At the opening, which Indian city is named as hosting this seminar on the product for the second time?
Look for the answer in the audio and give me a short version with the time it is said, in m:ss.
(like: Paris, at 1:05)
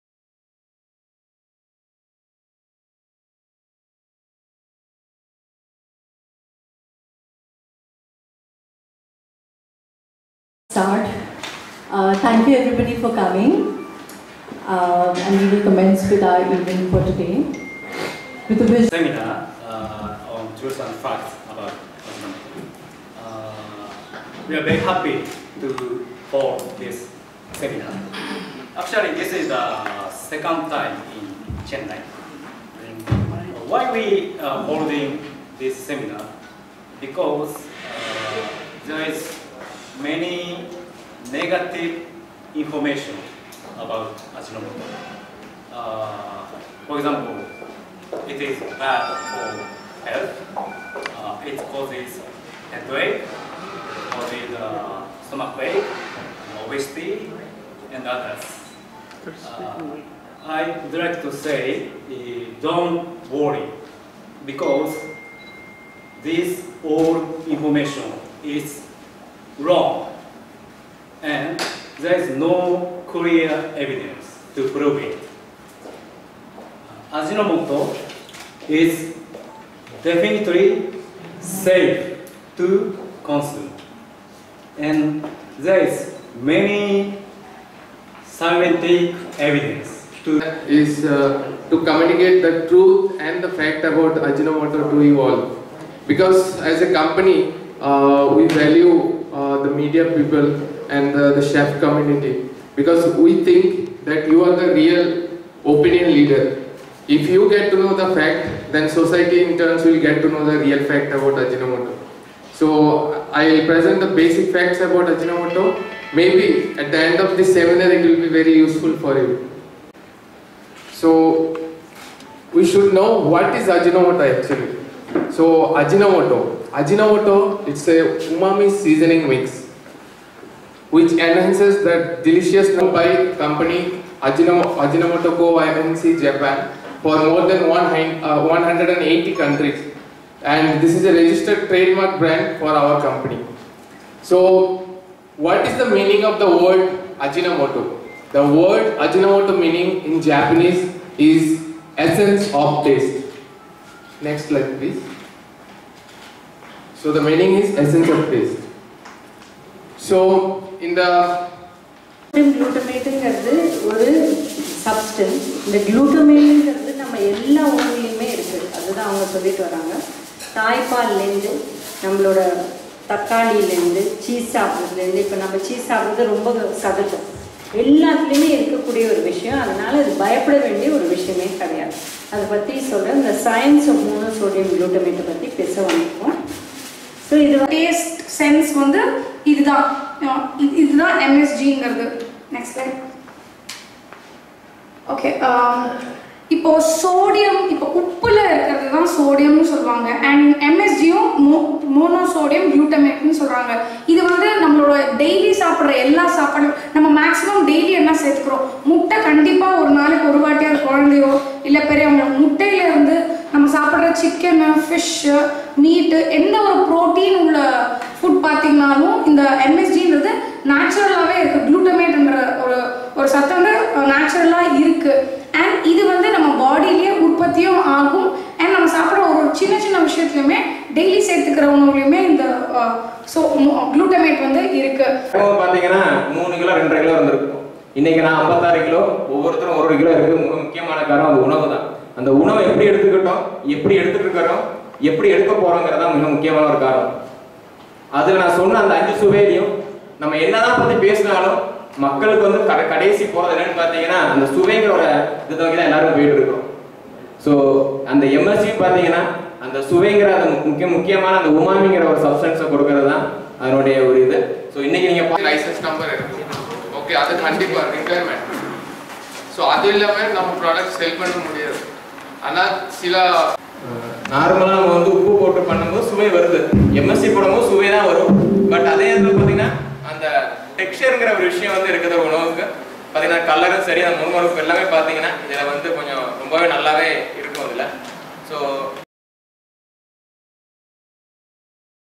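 Chennai, at 0:31.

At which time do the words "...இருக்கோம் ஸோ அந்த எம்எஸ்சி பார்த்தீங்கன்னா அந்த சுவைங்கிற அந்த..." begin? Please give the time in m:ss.
4:16.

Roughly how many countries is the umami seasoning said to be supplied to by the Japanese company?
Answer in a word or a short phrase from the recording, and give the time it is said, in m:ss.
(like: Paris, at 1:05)
180, at 2:17.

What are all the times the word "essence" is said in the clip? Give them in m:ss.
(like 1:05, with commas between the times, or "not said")
2:31, 2:37.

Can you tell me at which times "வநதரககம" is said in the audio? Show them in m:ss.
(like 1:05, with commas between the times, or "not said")
3:05, 3:57.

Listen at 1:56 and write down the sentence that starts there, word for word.
Maybe at the end of this seminar it will be very useful for you.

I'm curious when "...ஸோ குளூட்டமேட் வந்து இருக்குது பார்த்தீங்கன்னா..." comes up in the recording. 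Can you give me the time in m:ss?
3:53.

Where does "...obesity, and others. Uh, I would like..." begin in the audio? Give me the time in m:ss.
0:56.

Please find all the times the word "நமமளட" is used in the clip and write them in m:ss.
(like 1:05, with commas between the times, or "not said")
2:52, 3:24.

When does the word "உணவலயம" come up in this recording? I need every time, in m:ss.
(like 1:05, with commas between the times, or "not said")
2:47, 3:51.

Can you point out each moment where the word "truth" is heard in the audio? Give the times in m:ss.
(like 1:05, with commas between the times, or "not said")
0:20, 1:32.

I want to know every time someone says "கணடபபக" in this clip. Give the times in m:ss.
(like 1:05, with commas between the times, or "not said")
3:29, 4:27.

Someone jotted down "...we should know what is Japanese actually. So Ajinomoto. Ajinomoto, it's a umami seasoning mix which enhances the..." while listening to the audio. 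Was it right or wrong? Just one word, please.
wrong.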